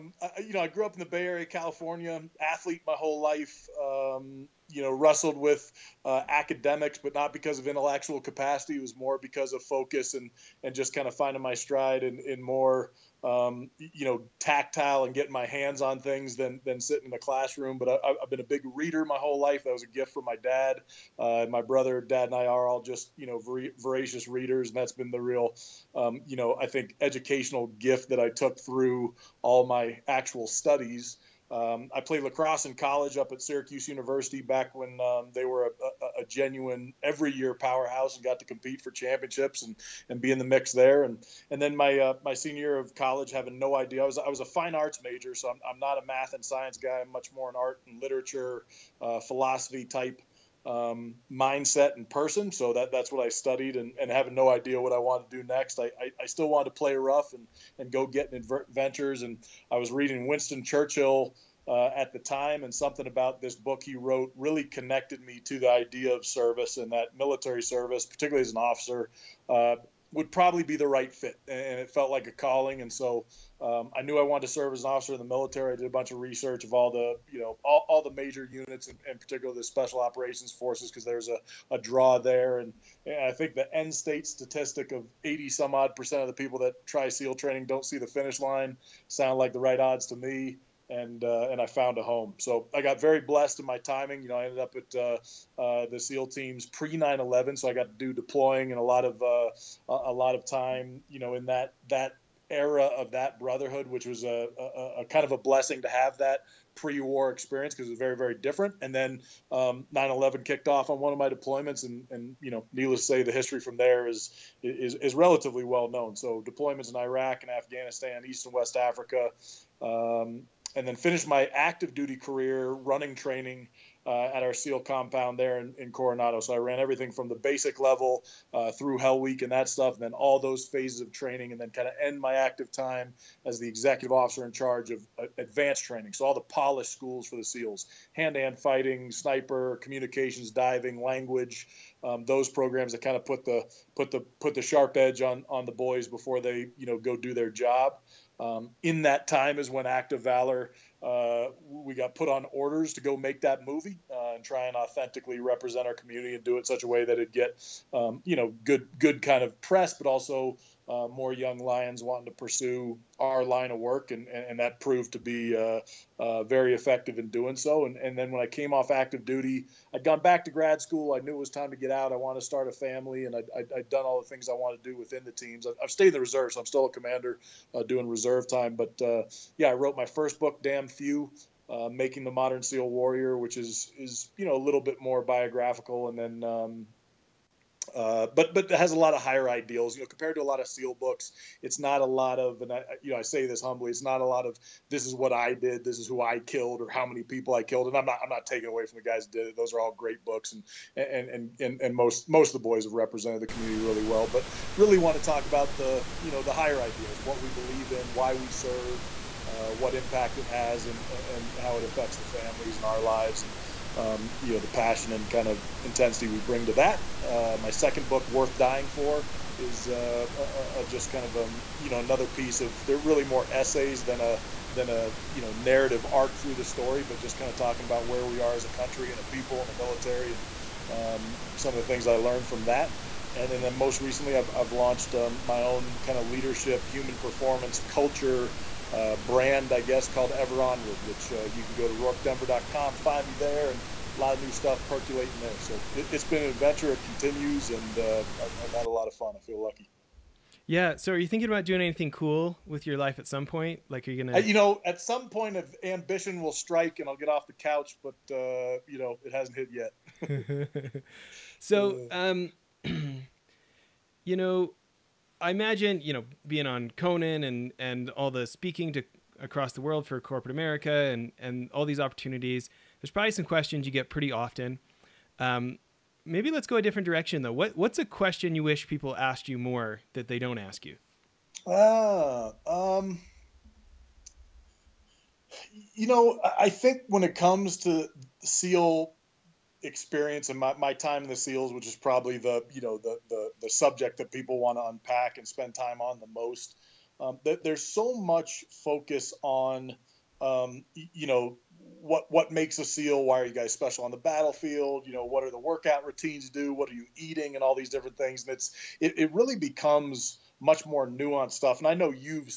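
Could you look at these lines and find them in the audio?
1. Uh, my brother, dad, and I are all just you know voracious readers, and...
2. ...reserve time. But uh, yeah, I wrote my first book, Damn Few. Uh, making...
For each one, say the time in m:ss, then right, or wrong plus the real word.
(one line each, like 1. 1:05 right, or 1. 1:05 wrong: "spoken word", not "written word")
1. 0:21 right
2. 2:58 right.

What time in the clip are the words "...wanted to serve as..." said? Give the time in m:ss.
1:14.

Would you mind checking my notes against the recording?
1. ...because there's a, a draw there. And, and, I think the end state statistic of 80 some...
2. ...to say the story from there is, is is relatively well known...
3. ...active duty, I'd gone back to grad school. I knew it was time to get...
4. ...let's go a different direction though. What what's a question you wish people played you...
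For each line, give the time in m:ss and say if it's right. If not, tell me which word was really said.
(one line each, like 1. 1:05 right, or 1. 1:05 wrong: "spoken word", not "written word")
1. 1:20 right
2. 1:52 wrong: "history", not "story"
3. 2:48 right
4. 4:36 wrong: "asked", not "played".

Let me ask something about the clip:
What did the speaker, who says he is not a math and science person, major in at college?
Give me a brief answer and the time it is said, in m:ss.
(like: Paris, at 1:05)
Fine arts, at 0:44.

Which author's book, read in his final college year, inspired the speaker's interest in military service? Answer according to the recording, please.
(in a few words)
Winston Churchill.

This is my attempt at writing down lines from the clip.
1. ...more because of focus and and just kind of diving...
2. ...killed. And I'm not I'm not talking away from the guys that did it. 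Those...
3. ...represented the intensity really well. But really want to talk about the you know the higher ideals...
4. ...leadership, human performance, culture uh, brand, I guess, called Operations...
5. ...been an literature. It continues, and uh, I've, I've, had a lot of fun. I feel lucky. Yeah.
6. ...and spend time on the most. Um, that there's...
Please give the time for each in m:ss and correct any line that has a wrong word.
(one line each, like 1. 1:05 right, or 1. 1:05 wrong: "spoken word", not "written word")
1. 0:08 wrong: "finding", not "diving"
2. 3:17 wrong: "taking", not "talking"
3. 3:22 wrong: "community", not "intensity"
4. 3:56 wrong: "Ever", not "Operations"
5. 4:06 wrong: "adventure", not "literature"
6. 4:55 right.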